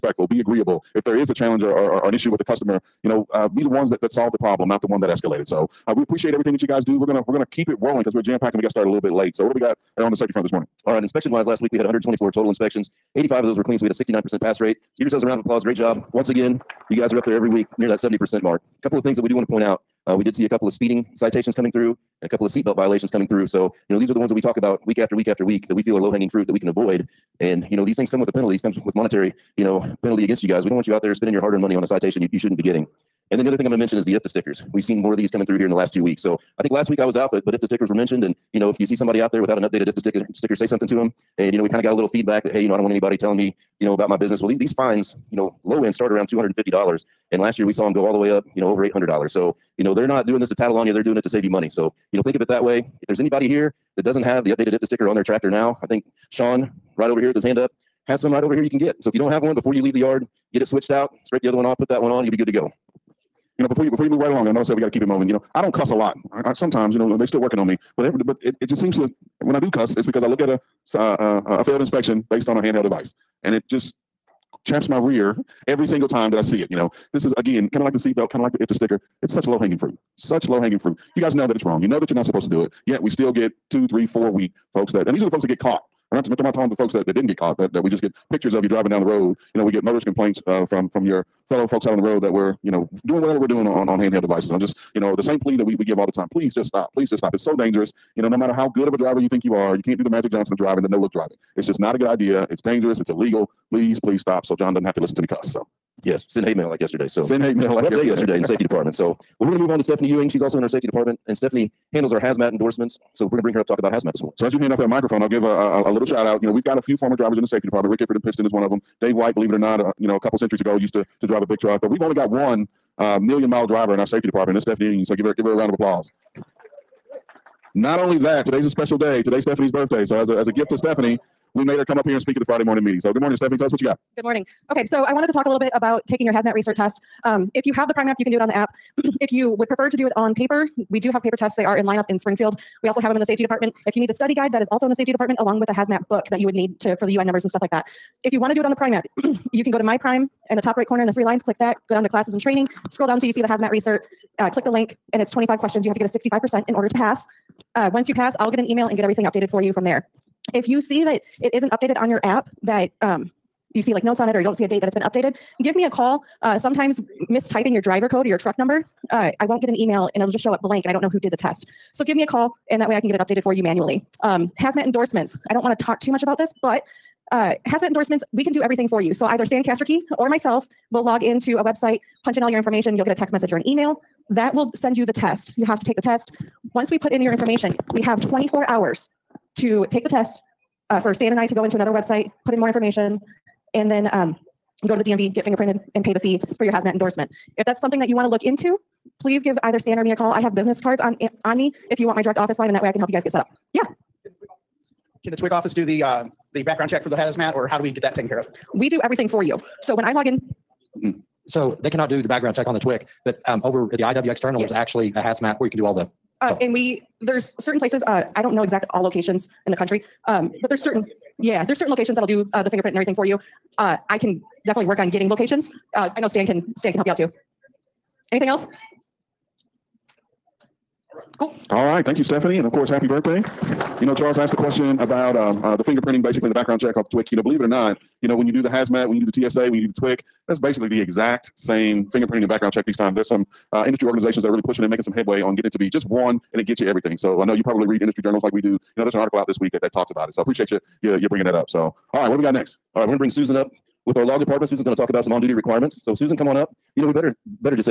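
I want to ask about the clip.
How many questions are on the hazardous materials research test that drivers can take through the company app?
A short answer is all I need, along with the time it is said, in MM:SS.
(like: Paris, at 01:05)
25, at 02:35.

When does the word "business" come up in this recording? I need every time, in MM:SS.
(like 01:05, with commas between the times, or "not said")
00:44, 03:20.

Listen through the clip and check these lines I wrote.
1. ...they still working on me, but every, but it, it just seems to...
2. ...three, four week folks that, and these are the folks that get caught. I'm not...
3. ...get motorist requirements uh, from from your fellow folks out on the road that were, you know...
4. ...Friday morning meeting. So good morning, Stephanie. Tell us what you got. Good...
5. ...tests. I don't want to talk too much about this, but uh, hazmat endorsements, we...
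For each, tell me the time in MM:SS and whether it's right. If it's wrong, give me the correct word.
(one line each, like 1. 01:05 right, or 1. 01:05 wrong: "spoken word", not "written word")
1. 01:07 right
2. 01:23 right
3. 01:29 wrong: "complaints", not "requirements"
4. 02:12 right
5. 02:54 wrong: "endorsements", not "tests".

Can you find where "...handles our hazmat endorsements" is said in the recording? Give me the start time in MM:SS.
01:51.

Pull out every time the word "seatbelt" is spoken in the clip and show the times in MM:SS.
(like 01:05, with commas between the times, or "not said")
00:22, 01:17.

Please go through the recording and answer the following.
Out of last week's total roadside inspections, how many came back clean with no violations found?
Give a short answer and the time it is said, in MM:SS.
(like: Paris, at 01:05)
85, at 00:13.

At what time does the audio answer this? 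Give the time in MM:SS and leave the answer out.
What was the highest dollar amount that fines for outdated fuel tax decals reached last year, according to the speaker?
00:48.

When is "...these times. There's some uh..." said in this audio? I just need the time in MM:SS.
04:02.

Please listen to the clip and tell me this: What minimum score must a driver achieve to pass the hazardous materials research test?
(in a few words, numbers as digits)
65%.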